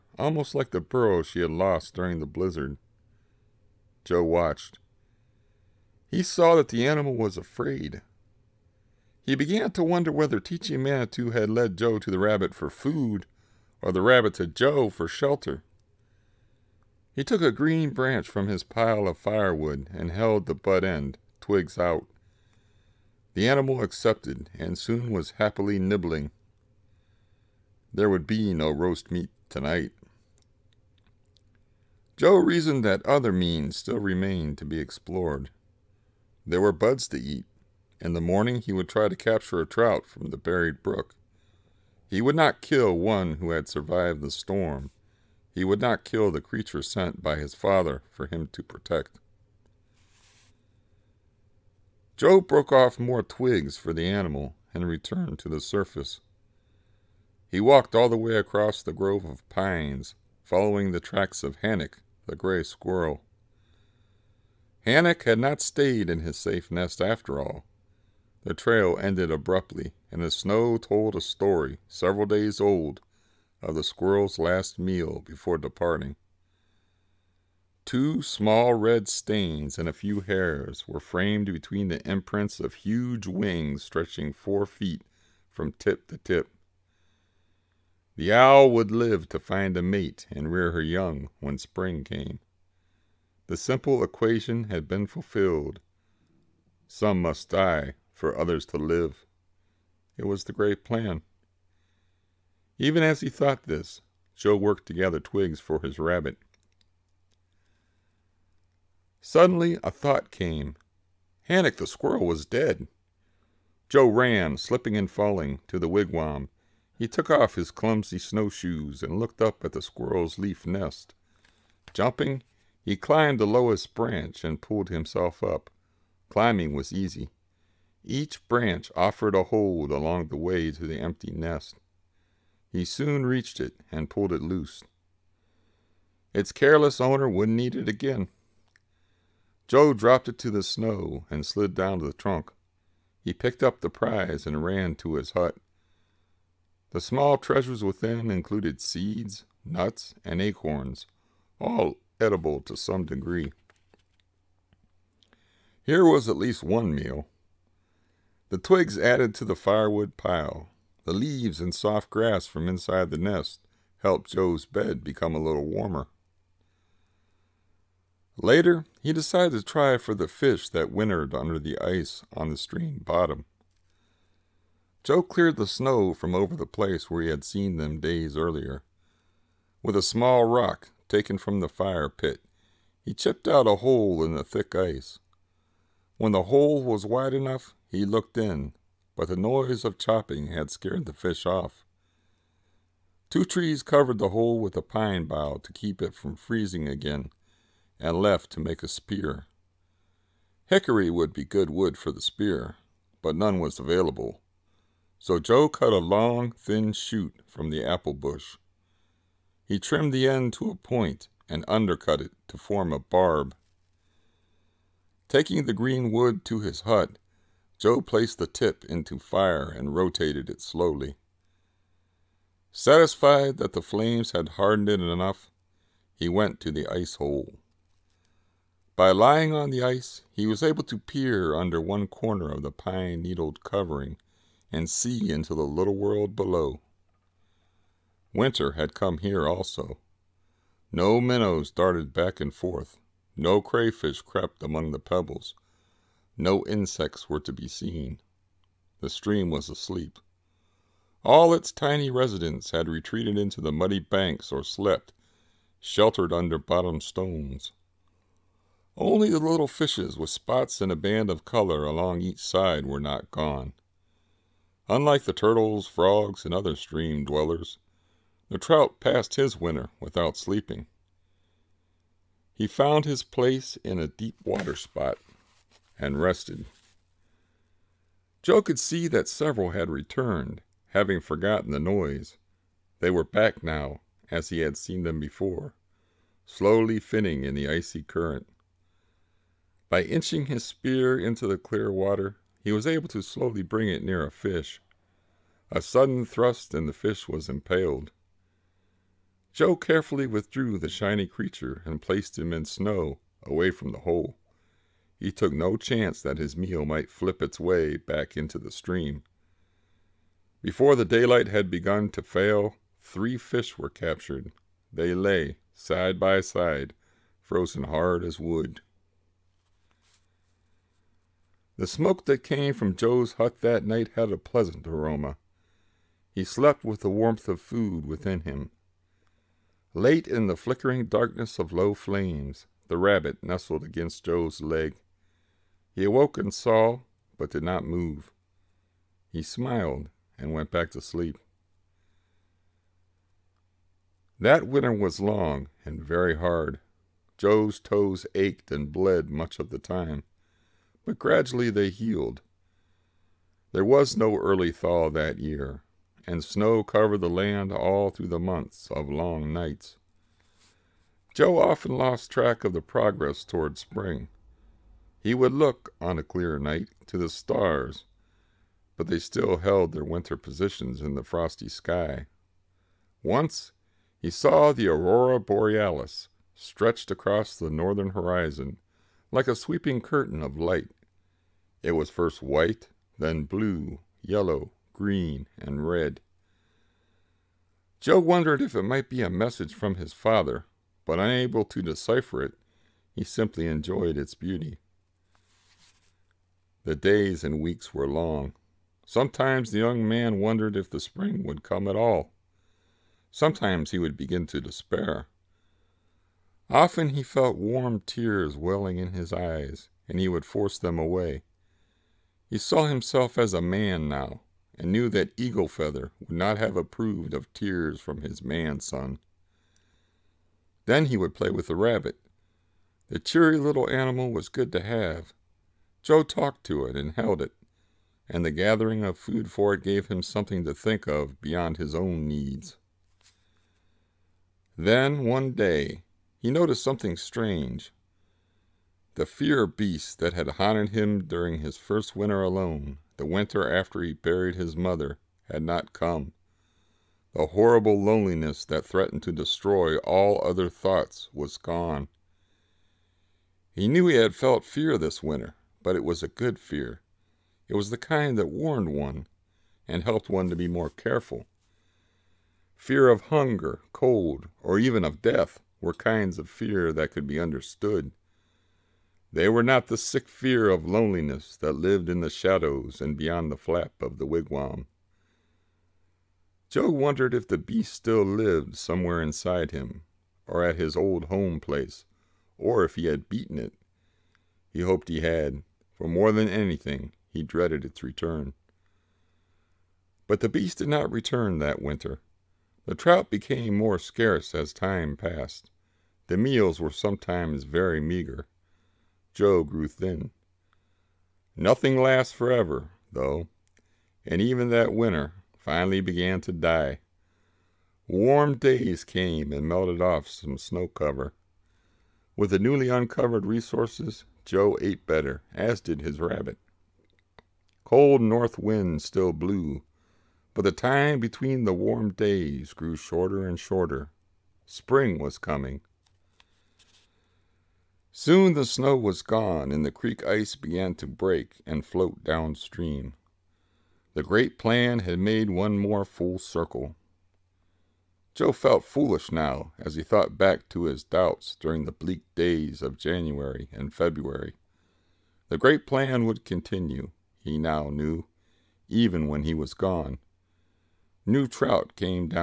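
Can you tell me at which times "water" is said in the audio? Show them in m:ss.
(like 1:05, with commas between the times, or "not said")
4:34, 4:51.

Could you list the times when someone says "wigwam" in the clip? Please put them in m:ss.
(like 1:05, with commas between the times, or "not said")
1:55, 7:54.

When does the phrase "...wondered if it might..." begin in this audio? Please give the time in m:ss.
6:28.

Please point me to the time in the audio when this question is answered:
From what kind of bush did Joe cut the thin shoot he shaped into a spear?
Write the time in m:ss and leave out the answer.
3:27.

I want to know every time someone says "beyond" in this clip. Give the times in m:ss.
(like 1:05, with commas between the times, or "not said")
7:11, 7:53.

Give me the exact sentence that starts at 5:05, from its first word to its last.
He took no chance that his meal might flip its way back into the stream.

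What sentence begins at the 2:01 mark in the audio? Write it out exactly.
Jumping, he climbed the lowest branch and pulled himself up.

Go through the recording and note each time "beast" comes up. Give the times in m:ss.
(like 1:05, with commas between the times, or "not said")
7:19, 7:57, 8:10.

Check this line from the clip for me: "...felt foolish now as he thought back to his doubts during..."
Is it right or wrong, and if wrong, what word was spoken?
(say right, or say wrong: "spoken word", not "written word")
right.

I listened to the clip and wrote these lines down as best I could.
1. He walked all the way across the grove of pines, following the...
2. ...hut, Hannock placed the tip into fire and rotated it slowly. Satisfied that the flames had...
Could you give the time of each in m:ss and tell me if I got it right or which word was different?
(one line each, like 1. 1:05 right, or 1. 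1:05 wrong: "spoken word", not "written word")
1. 0:57 right
2. 3:36 wrong: "Joe", not "Hannock".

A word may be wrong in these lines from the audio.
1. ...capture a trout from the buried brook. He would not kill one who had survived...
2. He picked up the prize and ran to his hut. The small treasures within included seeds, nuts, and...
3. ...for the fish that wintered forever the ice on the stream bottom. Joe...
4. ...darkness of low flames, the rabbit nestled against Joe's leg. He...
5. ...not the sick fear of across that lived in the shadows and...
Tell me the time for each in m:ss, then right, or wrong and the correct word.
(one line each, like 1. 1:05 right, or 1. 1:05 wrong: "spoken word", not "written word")
1. 0:39 right
2. 2:23 right
3. 2:49 wrong: "under", not "forever"
4. 5:31 right
5. 7:49 wrong: "loneliness", not "across".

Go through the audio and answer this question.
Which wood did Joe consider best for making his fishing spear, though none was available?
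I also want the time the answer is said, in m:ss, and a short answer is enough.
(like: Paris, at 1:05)
Hickory, at 3:20.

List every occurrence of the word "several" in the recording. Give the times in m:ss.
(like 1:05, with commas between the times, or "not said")
1:11, 4:39.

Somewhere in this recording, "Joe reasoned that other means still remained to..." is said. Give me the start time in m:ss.
0:32.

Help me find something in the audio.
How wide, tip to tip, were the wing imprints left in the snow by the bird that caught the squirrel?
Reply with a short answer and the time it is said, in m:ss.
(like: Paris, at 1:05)
four feet, at 1:24.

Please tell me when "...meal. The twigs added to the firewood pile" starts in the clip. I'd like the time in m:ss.
2:36.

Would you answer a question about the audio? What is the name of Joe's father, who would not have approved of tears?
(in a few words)
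Eagle Feather.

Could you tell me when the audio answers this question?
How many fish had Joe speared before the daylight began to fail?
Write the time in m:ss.
5:13.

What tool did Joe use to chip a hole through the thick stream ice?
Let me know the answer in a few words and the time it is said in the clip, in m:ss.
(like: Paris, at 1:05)
a small rock, at 2:59.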